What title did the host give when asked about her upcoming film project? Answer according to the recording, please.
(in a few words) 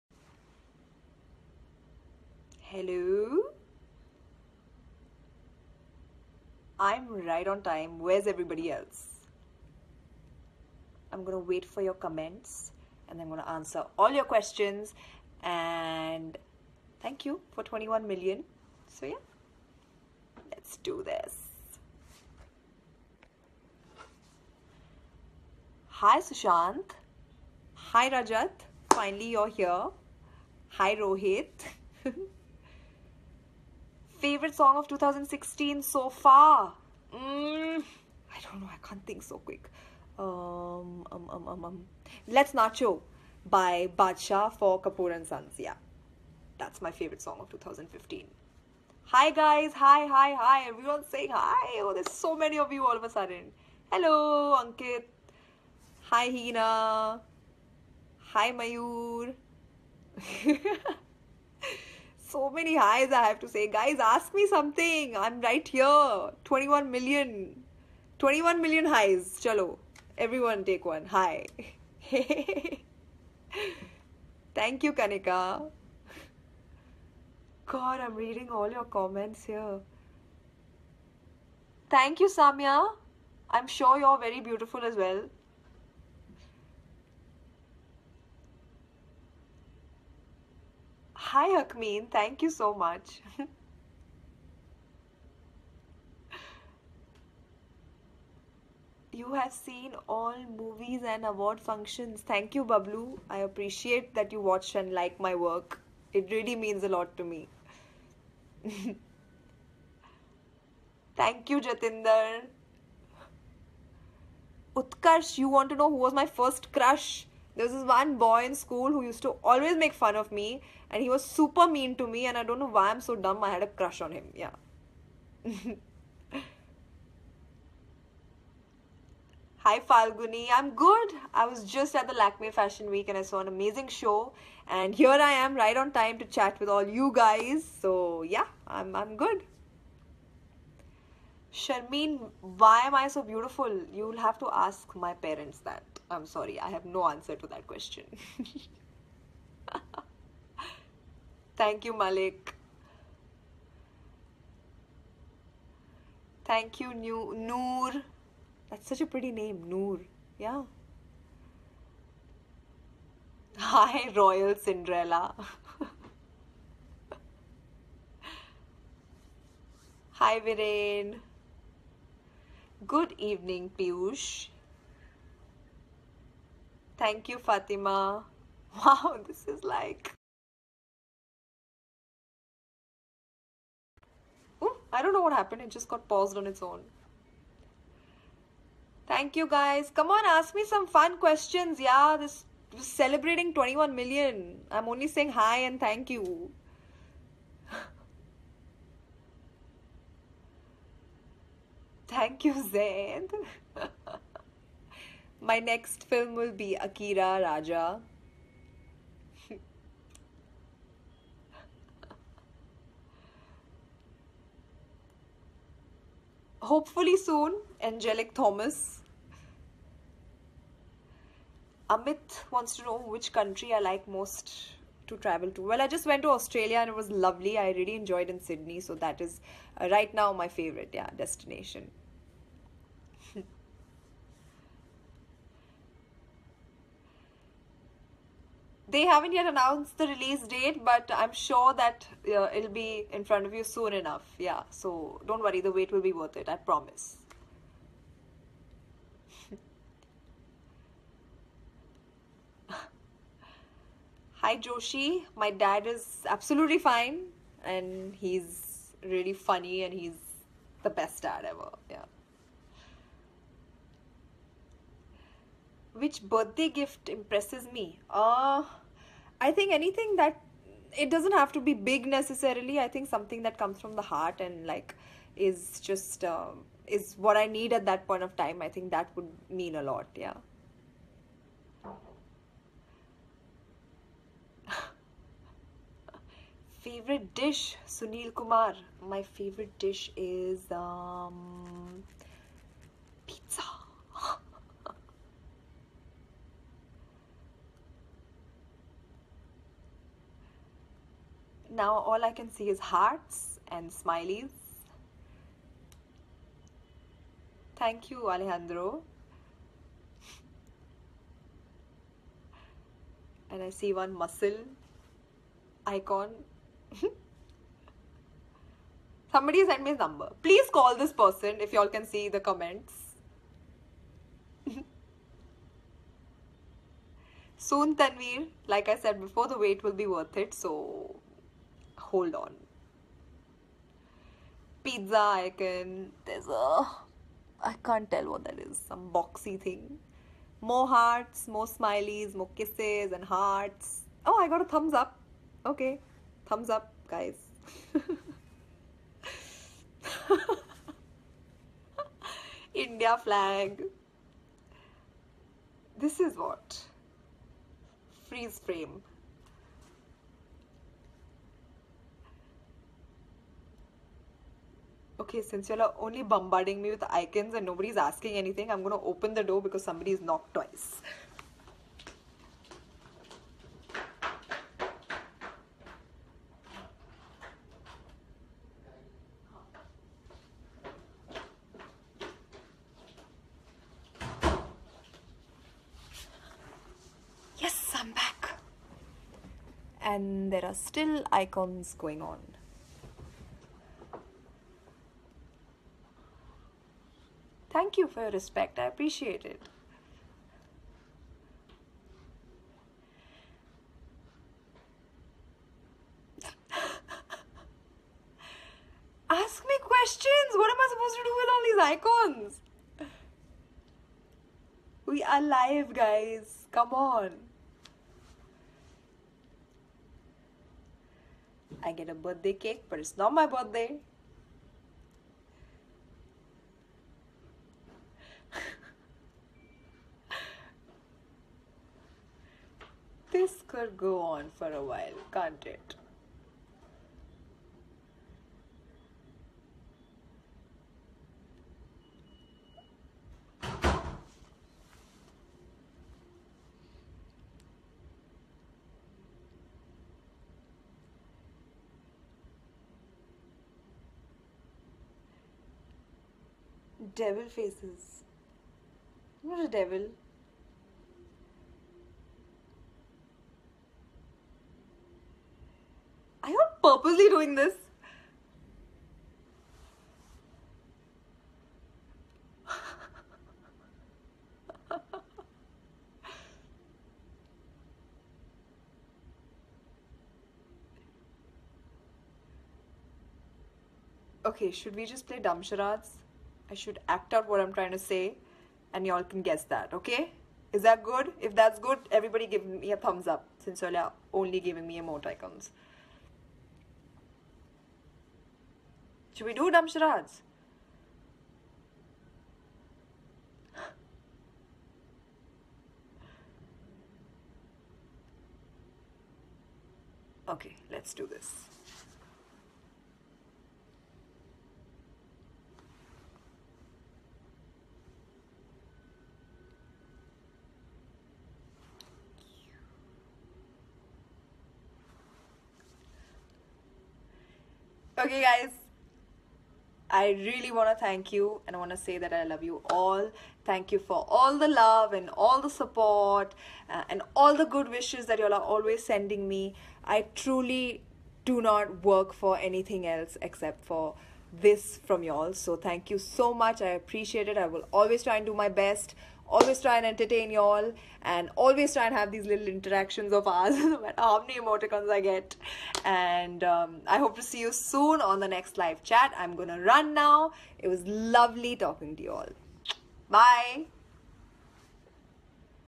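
Akira Raja.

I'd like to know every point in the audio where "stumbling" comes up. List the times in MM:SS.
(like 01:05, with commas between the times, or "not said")
not said.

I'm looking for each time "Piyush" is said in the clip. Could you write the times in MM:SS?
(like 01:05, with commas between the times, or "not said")
02:53.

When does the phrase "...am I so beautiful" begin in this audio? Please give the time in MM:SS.
02:22.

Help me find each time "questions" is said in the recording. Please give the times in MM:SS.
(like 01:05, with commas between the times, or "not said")
00:14, 02:27, 03:11, 06:49.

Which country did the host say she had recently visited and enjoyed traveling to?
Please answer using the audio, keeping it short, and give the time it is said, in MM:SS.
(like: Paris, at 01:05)
Australia, at 03:46.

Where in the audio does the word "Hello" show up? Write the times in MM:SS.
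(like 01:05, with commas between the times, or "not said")
00:02, 00:53.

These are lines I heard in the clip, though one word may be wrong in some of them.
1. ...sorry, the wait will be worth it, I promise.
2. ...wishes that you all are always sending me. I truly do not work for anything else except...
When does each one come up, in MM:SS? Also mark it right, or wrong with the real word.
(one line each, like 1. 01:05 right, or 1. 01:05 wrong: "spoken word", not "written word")
1. 04:05 wrong: "worry", not "sorry"
2. 08:57 right.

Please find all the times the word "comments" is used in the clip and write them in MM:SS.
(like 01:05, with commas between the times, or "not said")
00:12, 01:18, 05:22.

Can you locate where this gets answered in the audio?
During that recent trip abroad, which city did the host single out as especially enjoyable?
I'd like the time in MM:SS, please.
03:48.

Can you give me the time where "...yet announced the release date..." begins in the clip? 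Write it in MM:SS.
03:59.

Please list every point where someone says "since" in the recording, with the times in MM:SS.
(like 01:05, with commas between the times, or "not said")
06:05, 08:13.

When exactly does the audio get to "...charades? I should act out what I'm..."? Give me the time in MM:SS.
08:05.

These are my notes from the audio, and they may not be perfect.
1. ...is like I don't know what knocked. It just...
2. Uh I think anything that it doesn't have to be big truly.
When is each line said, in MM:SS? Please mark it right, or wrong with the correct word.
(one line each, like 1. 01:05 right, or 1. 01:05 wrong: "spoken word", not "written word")
1. 02:59 wrong: "happened", not "knocked"
2. 04:28 wrong: "necessarily", not "truly".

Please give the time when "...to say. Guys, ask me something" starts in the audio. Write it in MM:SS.
01:03.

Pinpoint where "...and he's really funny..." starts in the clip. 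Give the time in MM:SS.
04:17.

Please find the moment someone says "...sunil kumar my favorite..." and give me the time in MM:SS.
04:47.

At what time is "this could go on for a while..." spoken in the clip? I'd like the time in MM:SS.
07:13.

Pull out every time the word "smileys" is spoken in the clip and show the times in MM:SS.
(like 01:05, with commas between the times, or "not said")
05:03, 05:41.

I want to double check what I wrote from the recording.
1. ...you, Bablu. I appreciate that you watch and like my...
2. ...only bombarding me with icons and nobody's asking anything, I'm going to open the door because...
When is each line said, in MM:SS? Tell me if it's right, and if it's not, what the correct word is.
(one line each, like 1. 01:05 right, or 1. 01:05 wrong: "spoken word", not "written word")
1. 01:42 right
2. 06:05 right.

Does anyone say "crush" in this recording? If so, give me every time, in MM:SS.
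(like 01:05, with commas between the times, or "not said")
01:56, 02:03.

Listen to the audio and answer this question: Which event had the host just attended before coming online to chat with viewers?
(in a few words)
Lakme Fashion Week.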